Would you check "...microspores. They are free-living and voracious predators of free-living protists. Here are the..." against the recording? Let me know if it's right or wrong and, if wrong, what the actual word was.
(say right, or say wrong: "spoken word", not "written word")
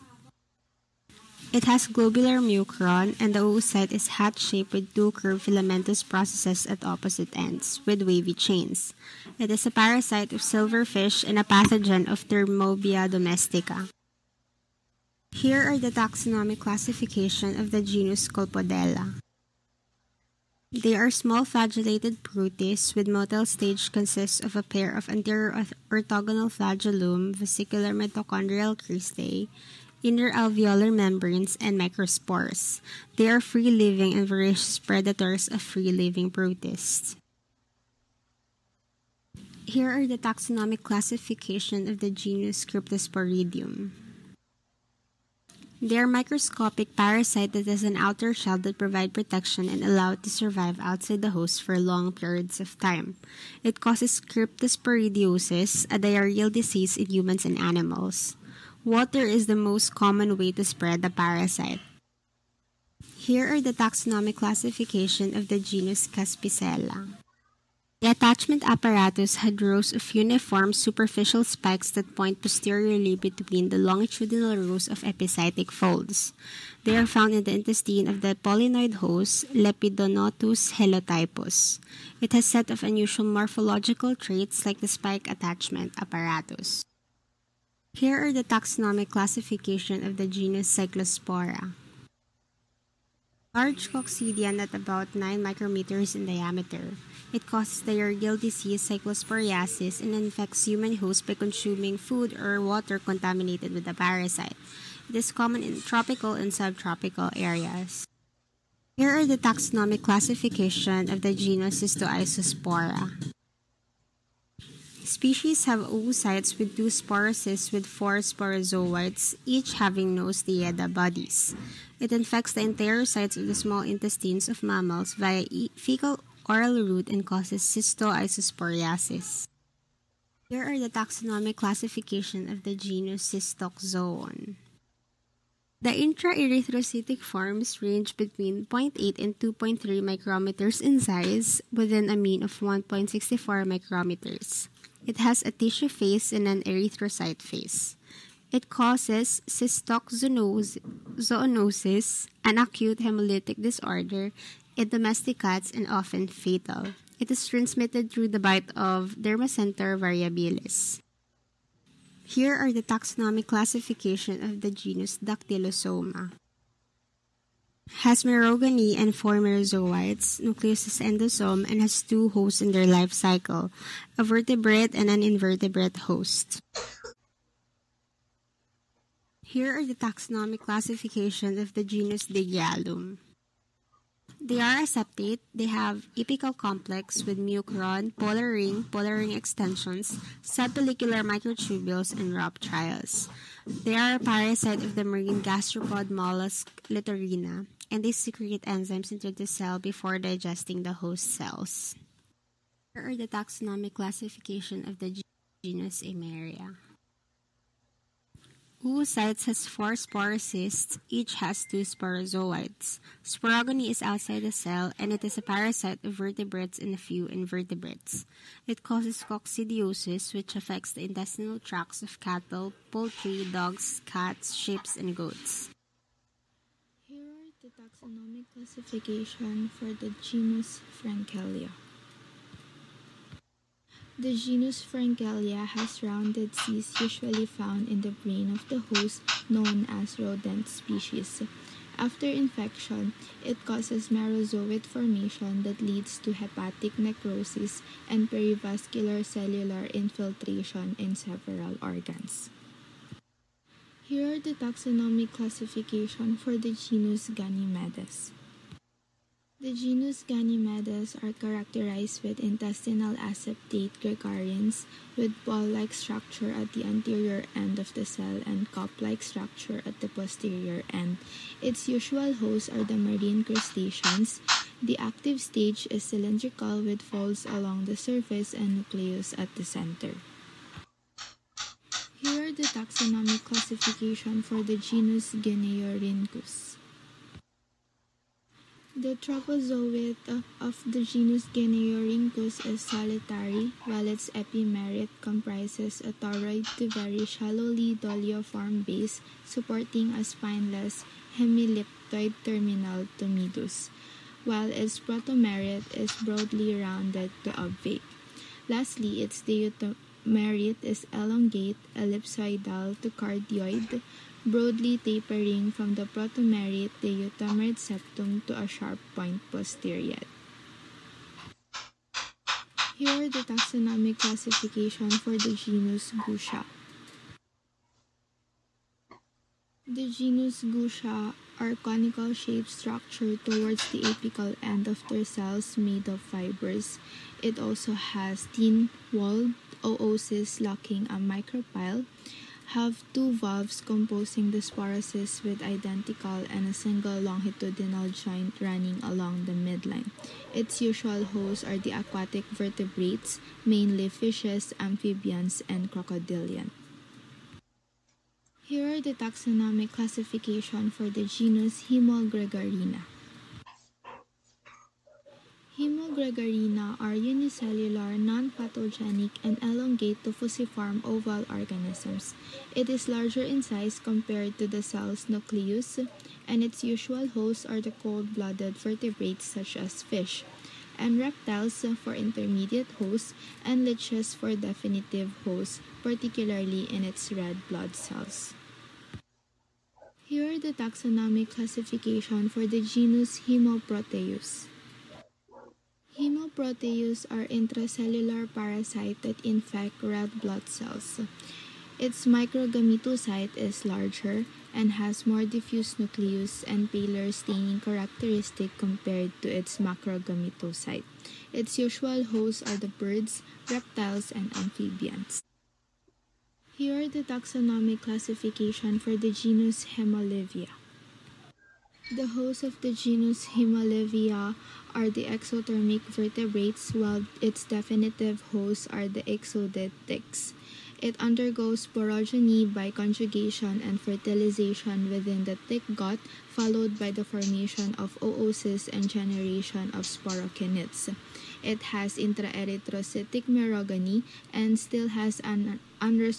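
right.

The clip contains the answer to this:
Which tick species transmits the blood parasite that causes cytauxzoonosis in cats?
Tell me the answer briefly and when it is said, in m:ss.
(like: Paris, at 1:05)
Dermacentor variabilis, at 2:39.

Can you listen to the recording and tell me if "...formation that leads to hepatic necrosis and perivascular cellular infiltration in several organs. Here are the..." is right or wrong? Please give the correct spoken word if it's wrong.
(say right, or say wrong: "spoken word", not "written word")
right.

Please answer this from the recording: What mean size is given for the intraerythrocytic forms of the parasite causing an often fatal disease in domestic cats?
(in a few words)
1.64 micrometers.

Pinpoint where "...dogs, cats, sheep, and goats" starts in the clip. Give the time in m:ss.
3:43.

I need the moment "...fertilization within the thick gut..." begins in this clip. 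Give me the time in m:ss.
7:13.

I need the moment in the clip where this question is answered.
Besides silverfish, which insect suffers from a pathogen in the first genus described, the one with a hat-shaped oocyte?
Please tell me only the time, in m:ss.
0:12.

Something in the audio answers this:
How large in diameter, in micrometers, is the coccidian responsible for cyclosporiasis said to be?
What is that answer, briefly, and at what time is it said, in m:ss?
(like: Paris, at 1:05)
9 micrometers, at 1:35.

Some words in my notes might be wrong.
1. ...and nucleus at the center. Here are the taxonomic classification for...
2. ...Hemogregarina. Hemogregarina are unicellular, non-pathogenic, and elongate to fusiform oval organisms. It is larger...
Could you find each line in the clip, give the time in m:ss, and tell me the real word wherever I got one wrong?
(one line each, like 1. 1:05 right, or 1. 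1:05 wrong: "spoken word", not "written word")
1. 4:38 right
2. 6:01 right.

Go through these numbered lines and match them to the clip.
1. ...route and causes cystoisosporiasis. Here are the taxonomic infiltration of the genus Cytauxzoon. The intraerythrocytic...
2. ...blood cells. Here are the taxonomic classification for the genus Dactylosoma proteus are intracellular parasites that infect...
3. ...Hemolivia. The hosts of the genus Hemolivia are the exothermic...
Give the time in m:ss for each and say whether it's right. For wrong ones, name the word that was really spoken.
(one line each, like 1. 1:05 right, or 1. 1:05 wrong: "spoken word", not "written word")
1. 2:06 wrong: "classification", not "infiltration"
2. 6:27 wrong: "Hemoproteus", not "Dactylosoma"
3. 6:59 right.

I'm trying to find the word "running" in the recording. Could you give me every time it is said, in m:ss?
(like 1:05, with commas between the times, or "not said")
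5:48.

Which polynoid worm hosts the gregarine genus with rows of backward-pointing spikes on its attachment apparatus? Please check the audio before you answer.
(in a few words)
Lepidonotus helotypus.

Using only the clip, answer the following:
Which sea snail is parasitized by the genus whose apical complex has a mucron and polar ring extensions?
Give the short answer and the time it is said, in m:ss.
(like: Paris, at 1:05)
Littorina, at 3:16.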